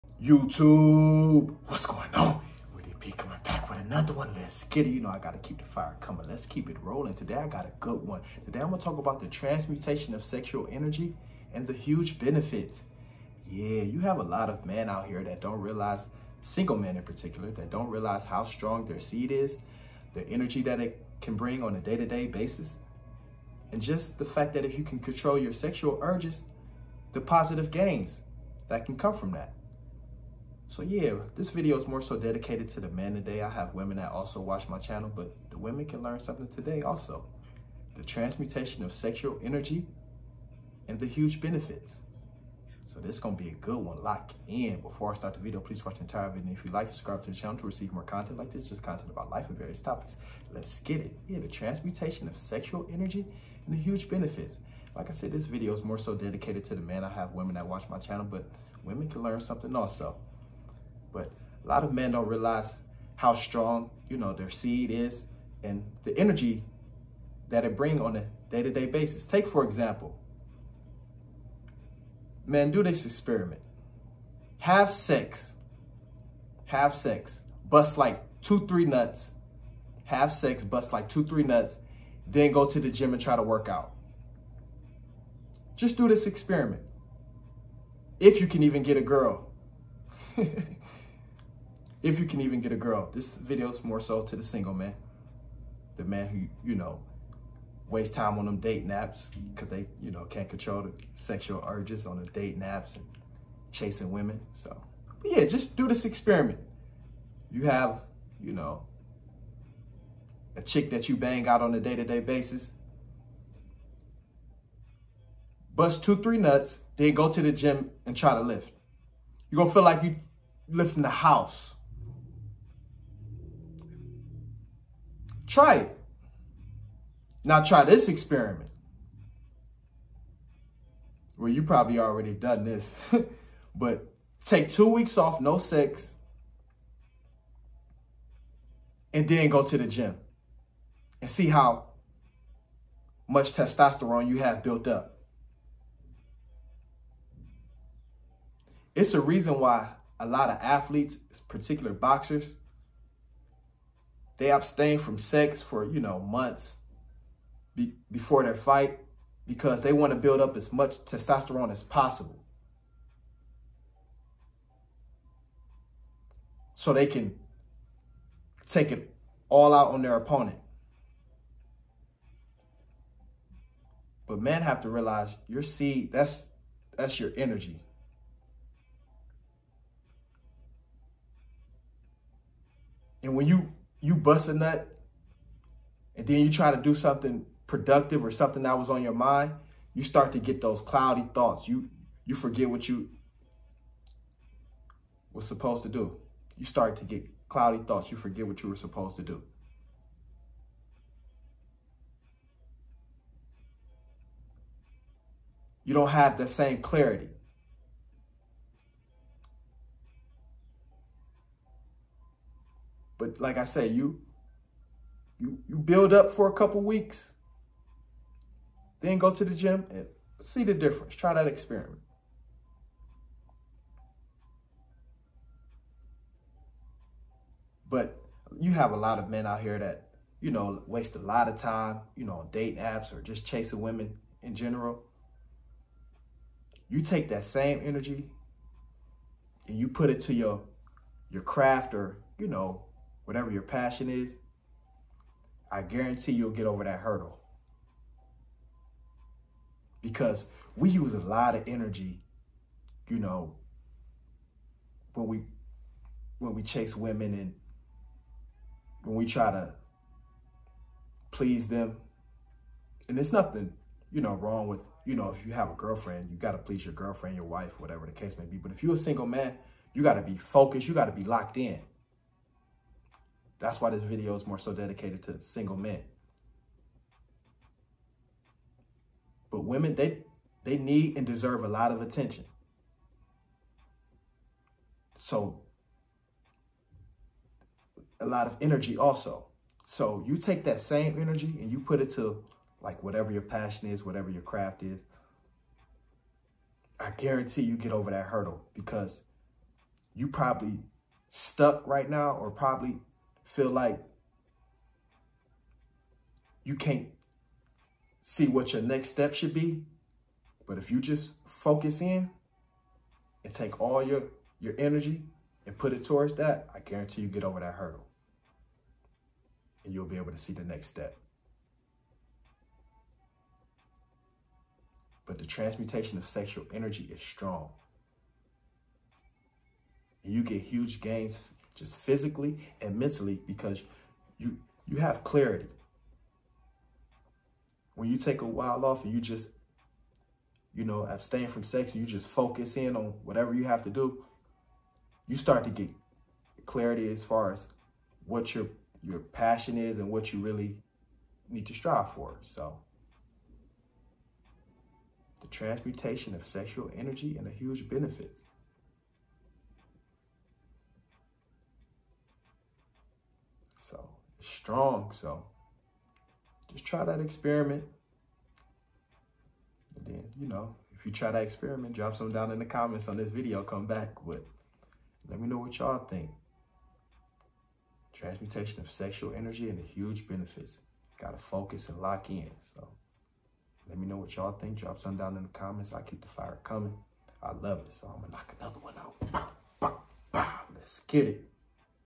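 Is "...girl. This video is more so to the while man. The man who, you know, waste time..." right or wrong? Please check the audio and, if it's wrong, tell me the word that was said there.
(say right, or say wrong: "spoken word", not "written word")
wrong: "single", not "while".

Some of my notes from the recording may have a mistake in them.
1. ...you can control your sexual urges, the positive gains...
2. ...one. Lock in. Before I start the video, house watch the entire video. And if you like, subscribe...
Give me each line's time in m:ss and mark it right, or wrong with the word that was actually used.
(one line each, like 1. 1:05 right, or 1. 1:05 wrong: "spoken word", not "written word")
1. 0:24 right
2. 0:43 wrong: "please", not "house".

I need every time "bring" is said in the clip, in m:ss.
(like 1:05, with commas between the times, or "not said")
0:21, 1:07.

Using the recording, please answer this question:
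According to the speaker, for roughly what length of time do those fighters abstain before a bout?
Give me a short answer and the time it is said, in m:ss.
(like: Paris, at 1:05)
months, at 2:36.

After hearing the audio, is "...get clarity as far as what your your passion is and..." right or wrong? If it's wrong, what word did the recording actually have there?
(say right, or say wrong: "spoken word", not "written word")
right.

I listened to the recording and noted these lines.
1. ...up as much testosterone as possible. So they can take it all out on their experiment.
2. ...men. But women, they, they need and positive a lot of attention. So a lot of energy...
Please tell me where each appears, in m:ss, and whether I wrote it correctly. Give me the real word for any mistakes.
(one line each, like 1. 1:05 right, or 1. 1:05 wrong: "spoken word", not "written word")
1. 2:40 wrong: "opponent", not "experiment"
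2. 4:35 wrong: "deserve", not "positive".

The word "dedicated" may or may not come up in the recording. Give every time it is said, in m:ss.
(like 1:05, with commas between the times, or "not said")
0:32, 0:56, 4:34.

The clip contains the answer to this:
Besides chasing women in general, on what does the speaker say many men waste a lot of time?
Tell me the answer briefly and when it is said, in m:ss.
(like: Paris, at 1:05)
dating apps, at 3:52.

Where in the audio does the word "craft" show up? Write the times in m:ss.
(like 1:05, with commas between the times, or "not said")
4:01, 4:54.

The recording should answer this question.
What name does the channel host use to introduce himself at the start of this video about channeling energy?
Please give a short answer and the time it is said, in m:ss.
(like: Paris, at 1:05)
Witty P, at 0:02.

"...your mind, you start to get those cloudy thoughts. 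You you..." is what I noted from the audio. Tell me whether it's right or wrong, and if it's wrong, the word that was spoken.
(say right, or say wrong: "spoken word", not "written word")
right.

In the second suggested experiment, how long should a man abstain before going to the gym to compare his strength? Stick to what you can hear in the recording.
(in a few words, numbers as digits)
two weeks.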